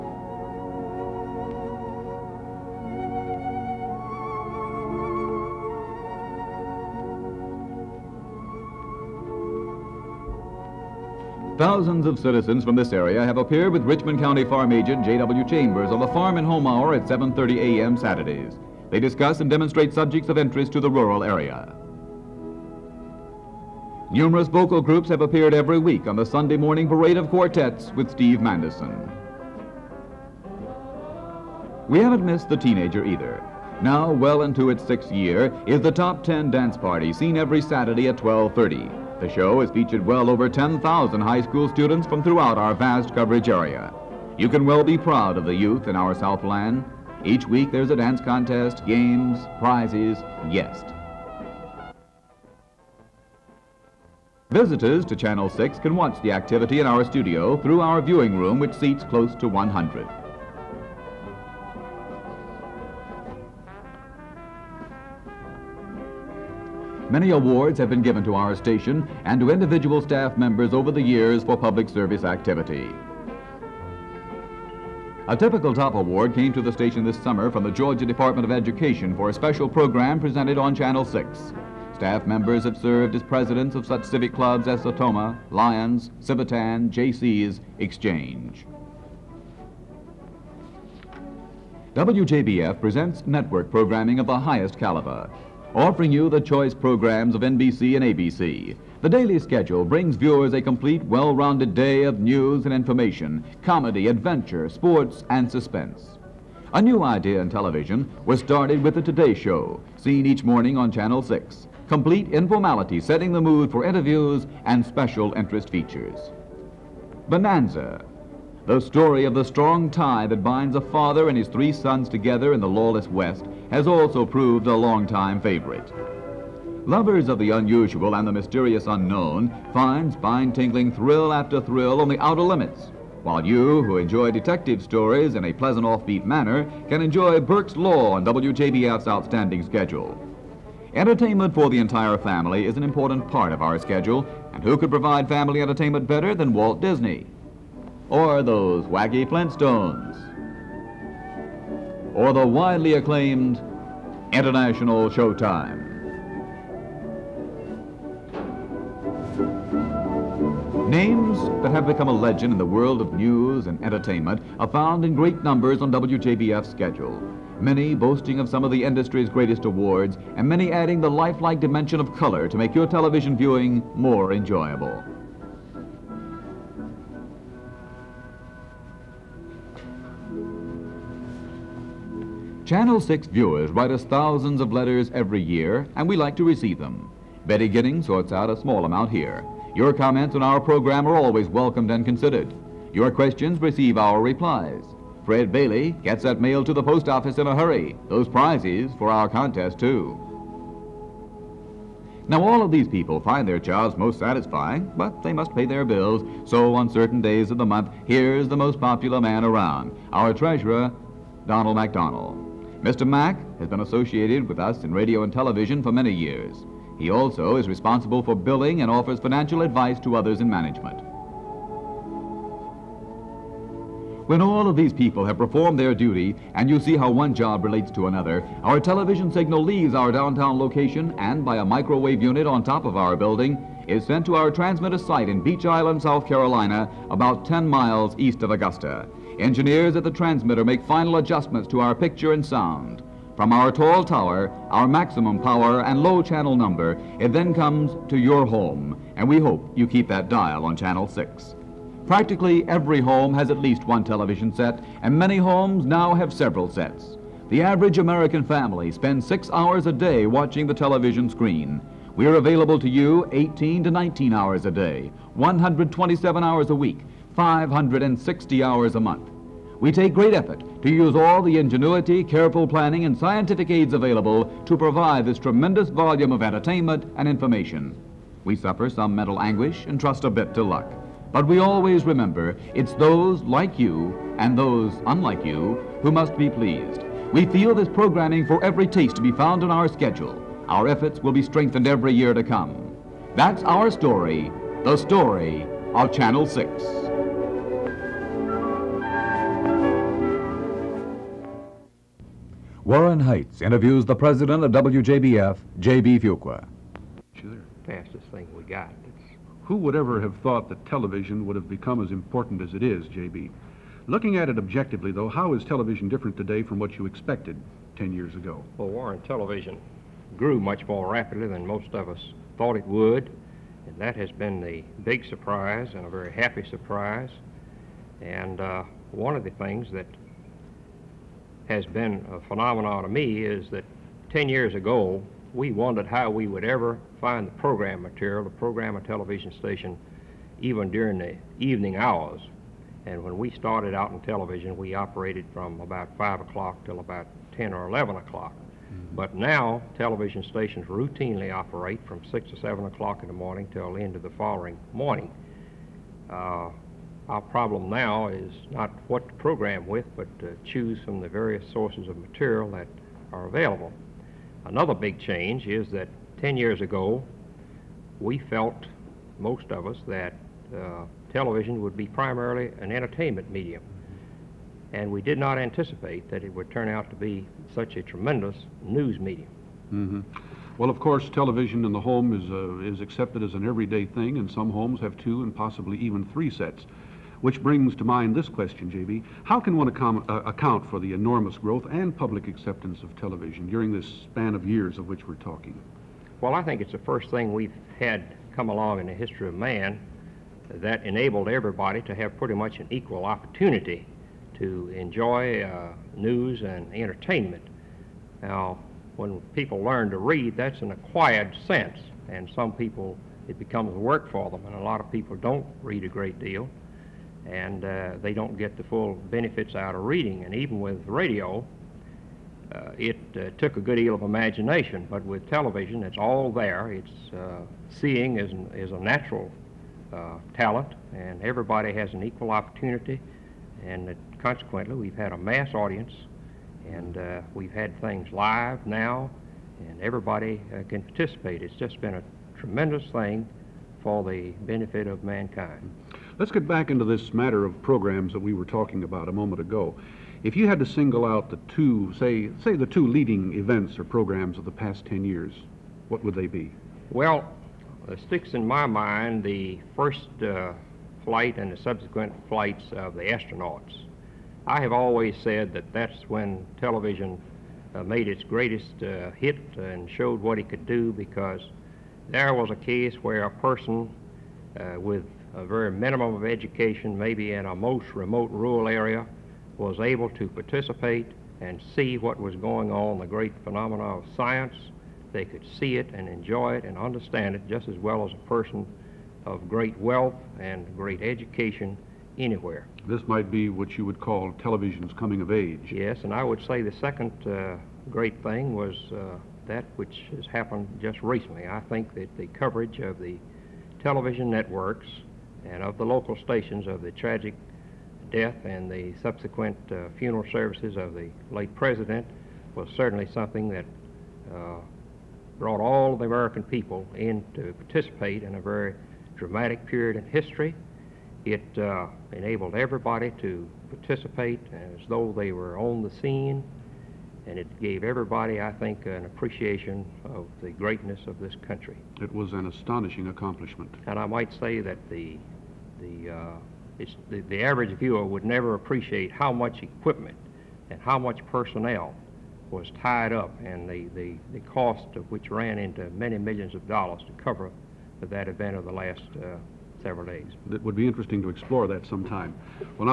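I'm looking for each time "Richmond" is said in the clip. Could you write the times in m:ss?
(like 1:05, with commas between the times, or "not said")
0:13.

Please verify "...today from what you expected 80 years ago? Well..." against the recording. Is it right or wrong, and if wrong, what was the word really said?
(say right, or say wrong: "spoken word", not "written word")
wrong: "10", not "80".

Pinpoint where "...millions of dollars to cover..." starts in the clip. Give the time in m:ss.
9:06.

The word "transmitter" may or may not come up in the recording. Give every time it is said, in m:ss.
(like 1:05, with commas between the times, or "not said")
3:54, 4:00.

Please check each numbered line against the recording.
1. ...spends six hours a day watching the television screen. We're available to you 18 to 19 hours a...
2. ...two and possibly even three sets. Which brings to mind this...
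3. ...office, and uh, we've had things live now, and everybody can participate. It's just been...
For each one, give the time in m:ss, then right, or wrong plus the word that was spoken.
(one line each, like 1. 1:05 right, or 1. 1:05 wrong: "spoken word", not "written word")
1. 4:18 right
2. 6:25 right
3. 7:15 wrong: "audience", not "office".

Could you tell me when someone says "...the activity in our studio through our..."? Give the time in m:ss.
0:56.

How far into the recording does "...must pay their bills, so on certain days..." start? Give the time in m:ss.
3:25.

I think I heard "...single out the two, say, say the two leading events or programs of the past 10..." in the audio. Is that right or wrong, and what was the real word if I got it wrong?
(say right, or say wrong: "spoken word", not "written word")
right.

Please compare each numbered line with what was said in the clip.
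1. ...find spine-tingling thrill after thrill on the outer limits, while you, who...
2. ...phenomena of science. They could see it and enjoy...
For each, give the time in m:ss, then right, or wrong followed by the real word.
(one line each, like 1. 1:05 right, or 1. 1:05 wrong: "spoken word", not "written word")
1. 2:09 right
2. 8:03 right.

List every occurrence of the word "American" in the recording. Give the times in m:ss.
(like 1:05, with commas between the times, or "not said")
4:17, 8:36.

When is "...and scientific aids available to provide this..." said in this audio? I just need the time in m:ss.
4:33.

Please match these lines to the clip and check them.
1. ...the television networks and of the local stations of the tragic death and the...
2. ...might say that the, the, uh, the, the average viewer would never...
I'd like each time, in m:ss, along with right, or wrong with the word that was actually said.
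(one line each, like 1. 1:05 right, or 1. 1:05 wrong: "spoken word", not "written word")
1. 8:23 right
2. 8:54 right.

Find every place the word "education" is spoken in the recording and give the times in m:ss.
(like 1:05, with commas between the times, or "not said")
1:18, 7:56, 8:11.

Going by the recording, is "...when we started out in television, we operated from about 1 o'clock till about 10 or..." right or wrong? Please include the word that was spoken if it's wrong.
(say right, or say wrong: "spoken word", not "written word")
wrong: "5", not "1".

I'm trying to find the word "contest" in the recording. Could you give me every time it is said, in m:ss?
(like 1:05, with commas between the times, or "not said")
0:48, 3:19.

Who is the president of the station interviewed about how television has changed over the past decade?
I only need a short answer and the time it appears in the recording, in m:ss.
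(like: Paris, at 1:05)
J.B. Fuqua, at 5:05.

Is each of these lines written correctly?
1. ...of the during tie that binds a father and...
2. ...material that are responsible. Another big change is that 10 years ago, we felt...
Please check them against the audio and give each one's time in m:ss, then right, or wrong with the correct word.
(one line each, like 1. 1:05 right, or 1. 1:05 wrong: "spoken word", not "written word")
1. 1:59 wrong: "strong", not "during"
2. 6:02 wrong: "available", not "responsible".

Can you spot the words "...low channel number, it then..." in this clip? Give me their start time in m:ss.
4:06.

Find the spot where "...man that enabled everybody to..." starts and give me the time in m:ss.
6:39.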